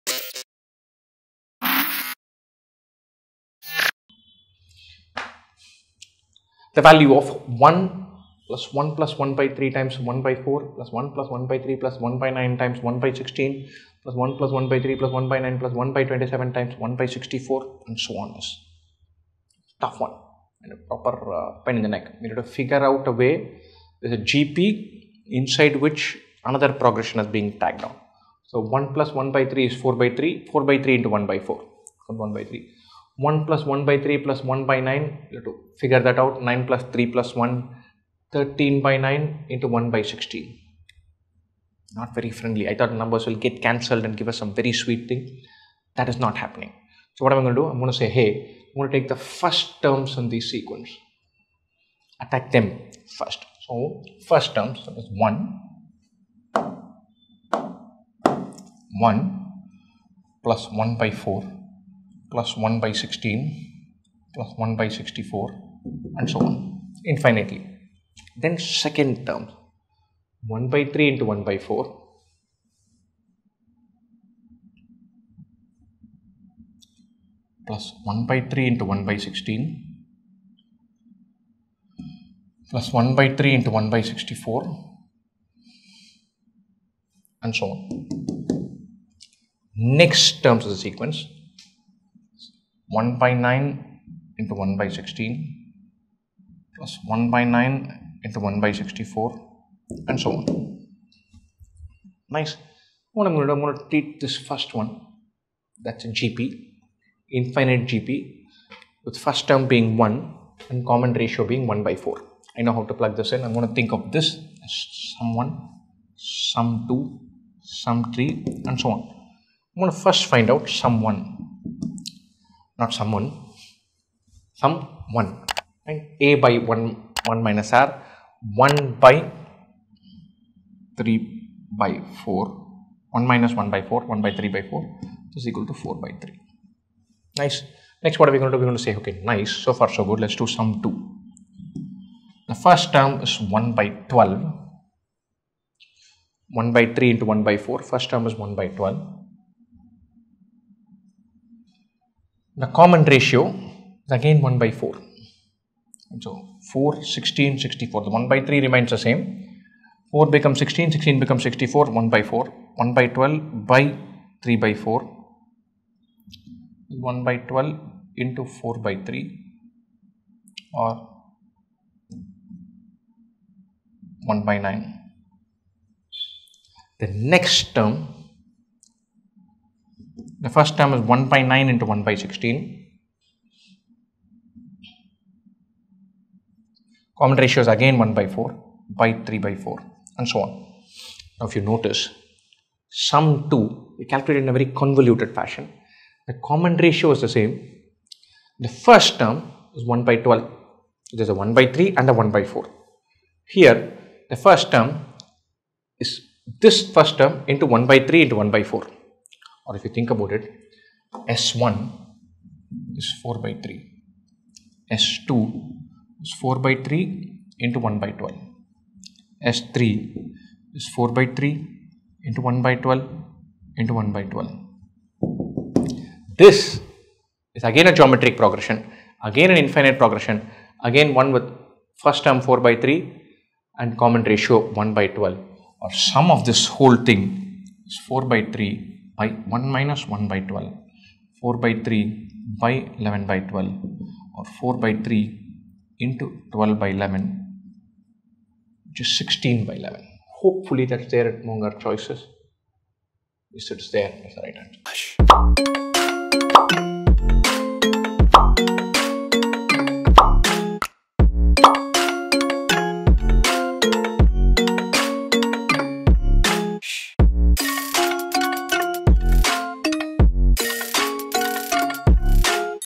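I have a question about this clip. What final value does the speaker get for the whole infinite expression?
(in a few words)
16/11.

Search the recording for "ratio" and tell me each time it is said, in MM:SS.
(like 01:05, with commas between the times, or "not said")
01:51, 02:33, 03:07, 03:16, 03:54.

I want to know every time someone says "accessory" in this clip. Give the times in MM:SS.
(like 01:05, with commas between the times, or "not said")
not said.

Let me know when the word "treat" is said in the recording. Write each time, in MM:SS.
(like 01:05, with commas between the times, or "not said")
01:43.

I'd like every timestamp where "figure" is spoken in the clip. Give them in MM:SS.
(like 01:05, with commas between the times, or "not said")
00:22, 00:35.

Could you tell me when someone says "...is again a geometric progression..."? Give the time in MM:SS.
03:47.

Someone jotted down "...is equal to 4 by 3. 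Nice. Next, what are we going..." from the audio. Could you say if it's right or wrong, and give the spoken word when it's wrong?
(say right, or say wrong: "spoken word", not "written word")
right.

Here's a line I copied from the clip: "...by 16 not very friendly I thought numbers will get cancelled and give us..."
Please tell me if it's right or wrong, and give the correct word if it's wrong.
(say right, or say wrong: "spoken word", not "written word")
right.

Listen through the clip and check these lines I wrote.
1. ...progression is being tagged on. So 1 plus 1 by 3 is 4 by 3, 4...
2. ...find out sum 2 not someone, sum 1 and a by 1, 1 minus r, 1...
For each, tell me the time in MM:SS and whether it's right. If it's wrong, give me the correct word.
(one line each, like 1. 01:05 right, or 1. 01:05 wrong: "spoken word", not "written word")
1. 00:26 right
2. 02:00 wrong: "1", not "2".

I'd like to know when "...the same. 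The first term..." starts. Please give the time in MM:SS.
03:17.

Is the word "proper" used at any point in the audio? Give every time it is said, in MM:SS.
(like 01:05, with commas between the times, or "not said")
00:20.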